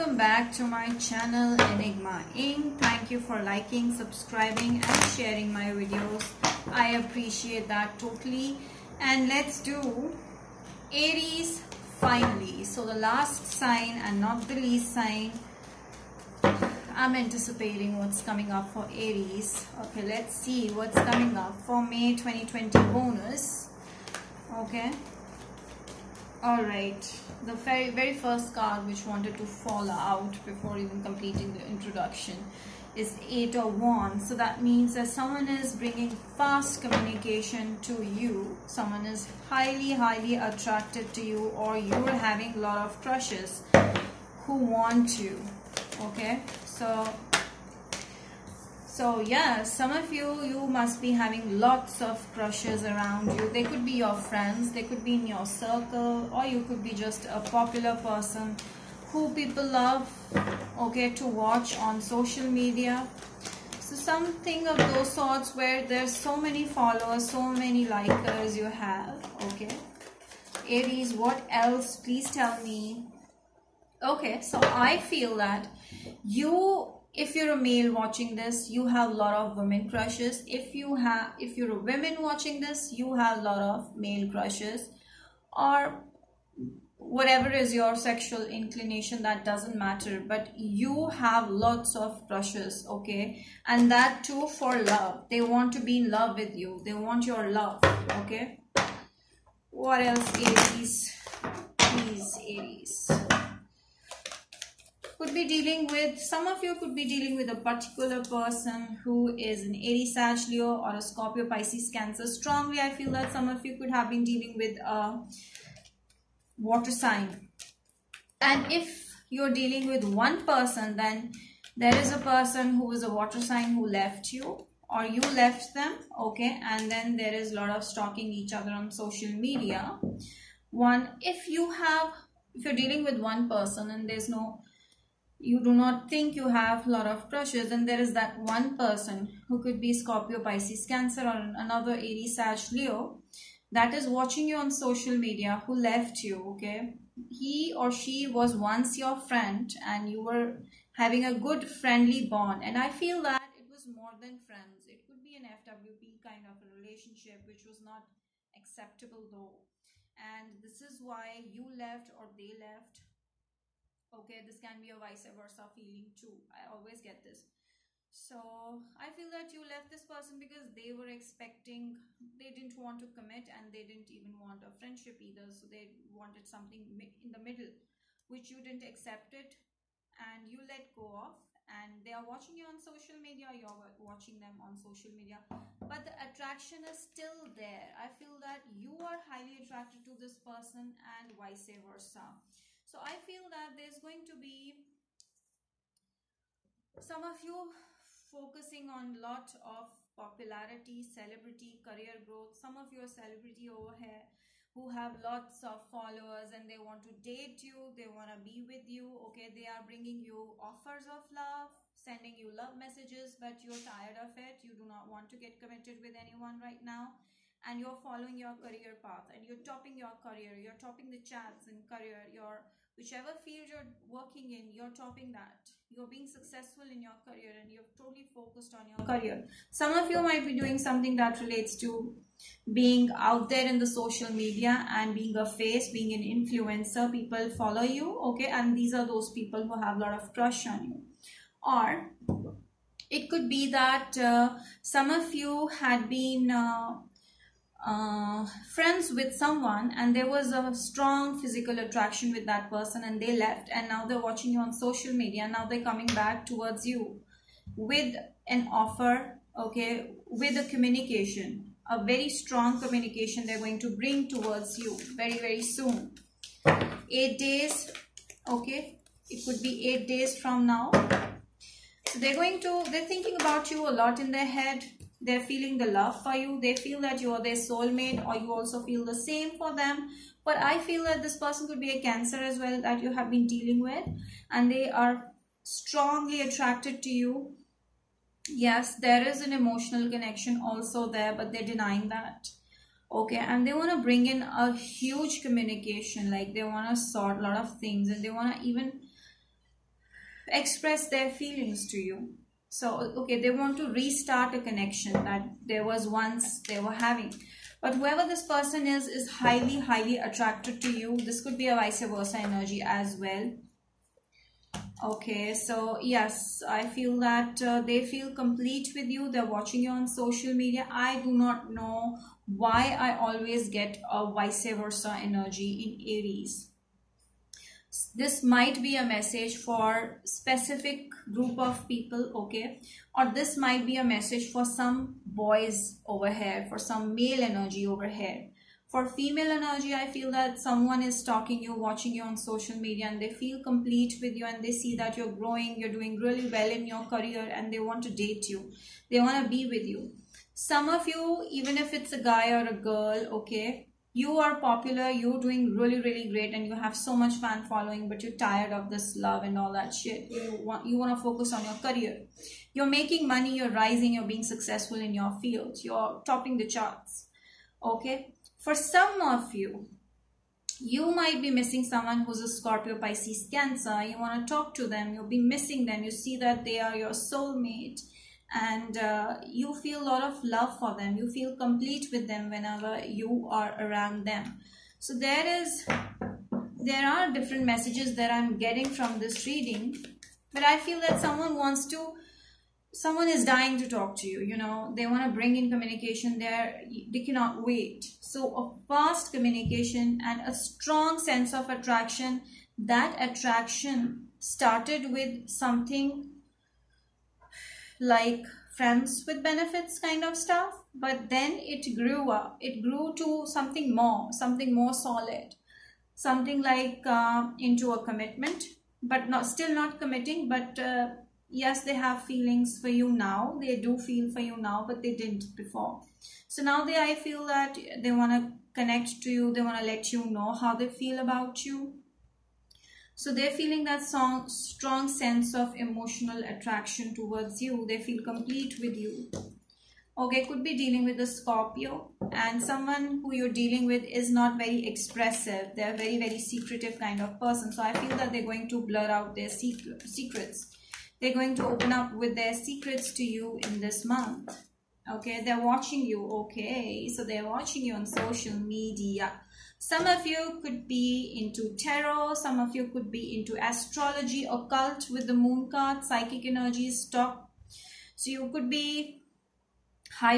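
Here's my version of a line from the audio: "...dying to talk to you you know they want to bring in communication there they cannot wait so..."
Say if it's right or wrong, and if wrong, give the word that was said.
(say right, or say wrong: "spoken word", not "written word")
right.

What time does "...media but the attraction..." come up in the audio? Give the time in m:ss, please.
3:05.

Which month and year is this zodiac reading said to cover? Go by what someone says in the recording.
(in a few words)
May 2020.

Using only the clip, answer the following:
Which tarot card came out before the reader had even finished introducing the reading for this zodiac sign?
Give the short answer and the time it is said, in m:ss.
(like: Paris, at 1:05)
Eight of Wands, at 0:33.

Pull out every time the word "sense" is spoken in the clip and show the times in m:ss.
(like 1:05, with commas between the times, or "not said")
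6:41, 7:15.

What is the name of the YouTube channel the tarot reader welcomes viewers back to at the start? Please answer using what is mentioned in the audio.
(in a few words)
Enigma Inc.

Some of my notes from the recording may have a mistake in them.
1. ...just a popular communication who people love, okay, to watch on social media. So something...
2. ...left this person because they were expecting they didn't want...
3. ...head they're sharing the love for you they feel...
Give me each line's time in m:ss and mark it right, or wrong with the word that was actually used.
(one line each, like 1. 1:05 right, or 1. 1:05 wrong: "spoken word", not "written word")
1. 0:56 wrong: "person", not "communication"
2. 2:49 right
3. 4:34 wrong: "feeling", not "sharing".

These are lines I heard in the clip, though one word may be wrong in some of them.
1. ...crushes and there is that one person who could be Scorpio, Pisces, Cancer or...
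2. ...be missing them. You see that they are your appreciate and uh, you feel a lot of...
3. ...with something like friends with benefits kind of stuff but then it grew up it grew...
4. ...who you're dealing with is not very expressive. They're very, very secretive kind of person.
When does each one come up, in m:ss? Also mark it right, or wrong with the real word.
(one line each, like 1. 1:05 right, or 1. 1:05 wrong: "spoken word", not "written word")
1. 2:17 right
2. 6:15 wrong: "soulmate", not "appreciate"
3. 6:45 right
4. 7:23 right.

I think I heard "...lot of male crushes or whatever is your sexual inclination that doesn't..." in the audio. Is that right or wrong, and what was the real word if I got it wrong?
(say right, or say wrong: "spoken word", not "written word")
right.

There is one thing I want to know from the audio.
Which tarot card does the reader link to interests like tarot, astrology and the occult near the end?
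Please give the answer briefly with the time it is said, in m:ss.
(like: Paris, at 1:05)
The Moon, at 7:45.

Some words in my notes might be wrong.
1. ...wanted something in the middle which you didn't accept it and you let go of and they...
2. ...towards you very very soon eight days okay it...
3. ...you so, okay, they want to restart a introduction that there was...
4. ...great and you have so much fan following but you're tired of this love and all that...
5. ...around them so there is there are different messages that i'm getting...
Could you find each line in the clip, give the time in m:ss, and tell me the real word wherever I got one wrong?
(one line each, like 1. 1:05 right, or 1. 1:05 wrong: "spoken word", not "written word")
1. 2:56 right
2. 4:24 right
3. 5:01 wrong: "connection", not "introduction"
4. 5:56 right
5. 6:23 right.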